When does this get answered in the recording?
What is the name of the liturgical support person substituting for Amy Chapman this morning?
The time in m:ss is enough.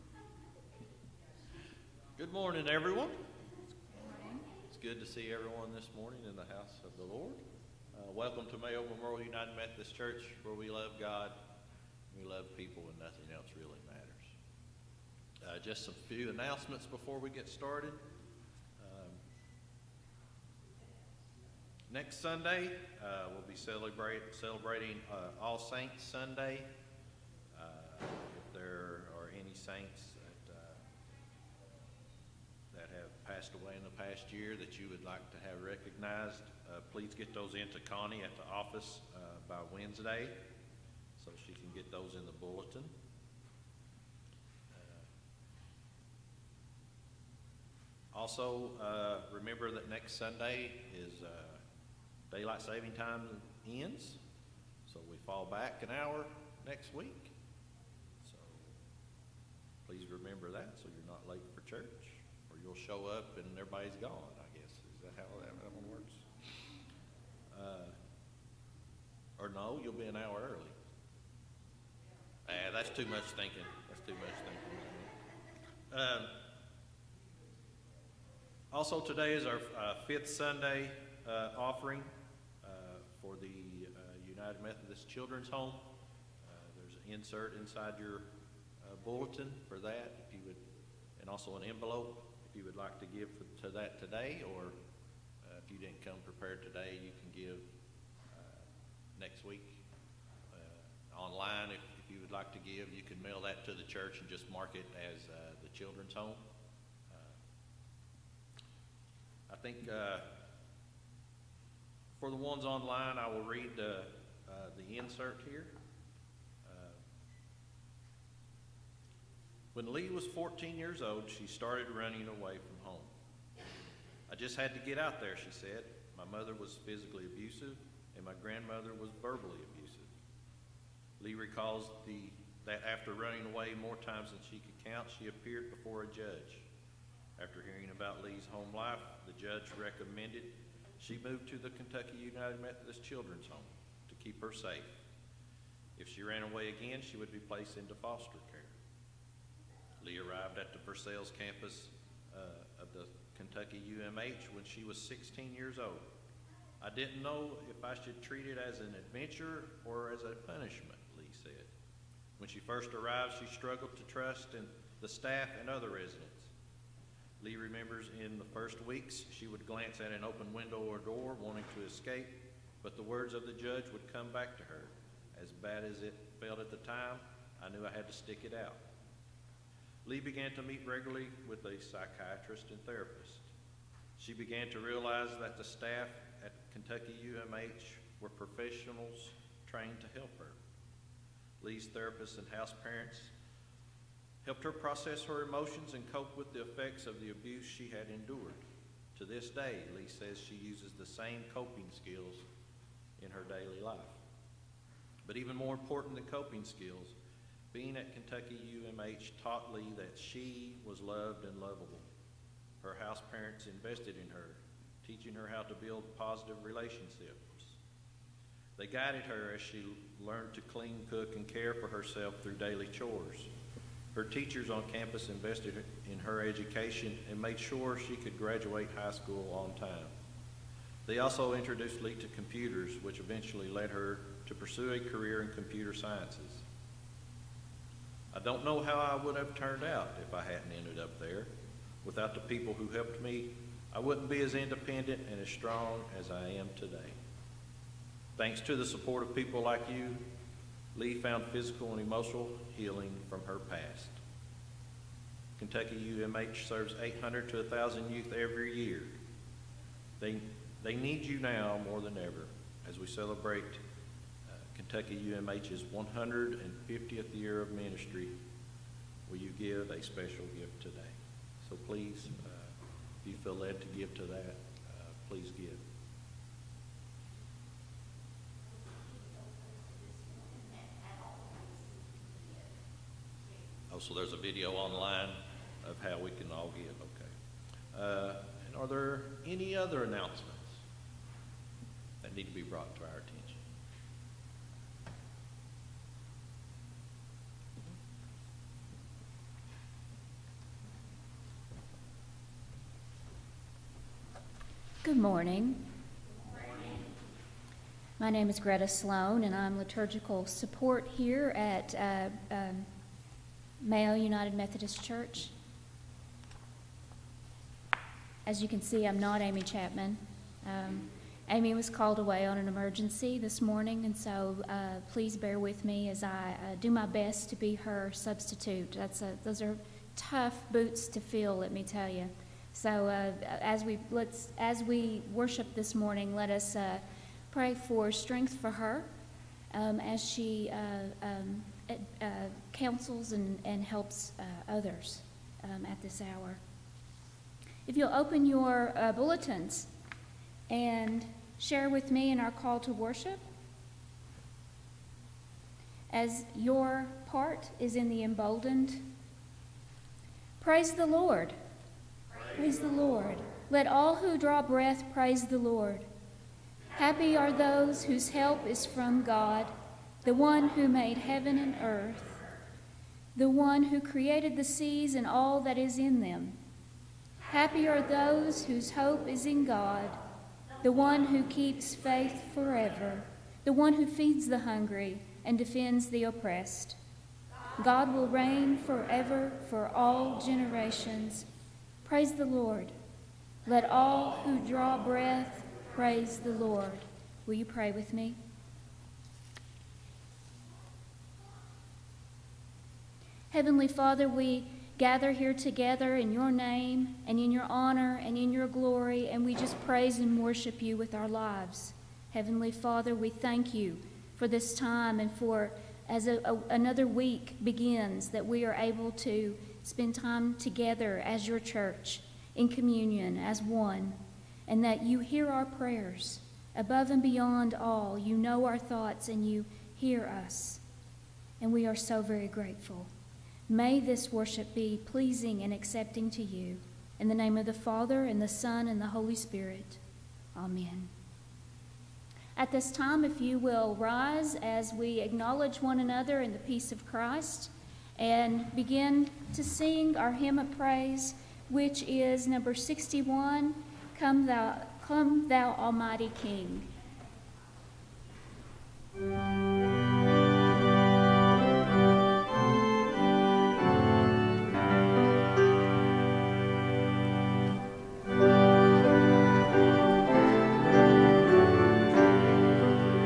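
5:08.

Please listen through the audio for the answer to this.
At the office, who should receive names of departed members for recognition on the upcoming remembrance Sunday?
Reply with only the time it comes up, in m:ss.
0:37.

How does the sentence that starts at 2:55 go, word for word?
As bad as it felt at the time, I knew I had to stick it out.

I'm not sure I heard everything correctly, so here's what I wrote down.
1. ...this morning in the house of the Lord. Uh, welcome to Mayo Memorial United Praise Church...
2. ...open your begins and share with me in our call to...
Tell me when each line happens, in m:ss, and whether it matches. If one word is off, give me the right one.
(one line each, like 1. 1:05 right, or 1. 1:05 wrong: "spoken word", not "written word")
1. 0:05 wrong: "Methodist", not "Praise"
2. 5:48 wrong: "bulletins", not "begins".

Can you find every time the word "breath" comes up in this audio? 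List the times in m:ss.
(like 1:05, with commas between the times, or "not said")
6:04, 6:35.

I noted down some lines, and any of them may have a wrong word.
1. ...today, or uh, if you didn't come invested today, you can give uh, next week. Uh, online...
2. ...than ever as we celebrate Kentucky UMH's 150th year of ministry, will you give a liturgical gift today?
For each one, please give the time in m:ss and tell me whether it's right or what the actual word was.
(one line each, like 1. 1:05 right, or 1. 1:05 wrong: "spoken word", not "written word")
1. 1:34 wrong: "prepared", not "invested"
2. 4:21 wrong: "special", not "liturgical".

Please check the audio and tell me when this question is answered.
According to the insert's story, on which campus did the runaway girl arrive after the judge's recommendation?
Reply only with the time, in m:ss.
2:30.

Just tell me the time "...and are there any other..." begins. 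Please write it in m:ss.
4:48.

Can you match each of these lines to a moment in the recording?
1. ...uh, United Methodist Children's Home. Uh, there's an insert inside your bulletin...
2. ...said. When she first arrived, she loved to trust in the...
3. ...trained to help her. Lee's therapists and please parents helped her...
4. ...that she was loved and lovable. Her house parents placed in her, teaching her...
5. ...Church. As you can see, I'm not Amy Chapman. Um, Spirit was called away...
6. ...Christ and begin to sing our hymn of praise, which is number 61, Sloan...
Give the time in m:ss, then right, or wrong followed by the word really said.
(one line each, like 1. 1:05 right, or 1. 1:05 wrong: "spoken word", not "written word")
1. 1:23 right
2. 2:41 wrong: "struggled", not "loved"
3. 3:09 wrong: "house", not "please"
4. 3:29 wrong: "invested", not "placed"
5. 5:15 wrong: "Amy", not "Spirit"
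6. 7:27 wrong: "Come", not "Sloan".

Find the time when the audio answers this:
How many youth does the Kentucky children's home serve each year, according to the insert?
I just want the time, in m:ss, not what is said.
4:16.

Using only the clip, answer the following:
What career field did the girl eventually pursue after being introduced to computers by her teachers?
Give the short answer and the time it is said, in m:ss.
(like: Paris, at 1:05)
computer sciences, at 3:55.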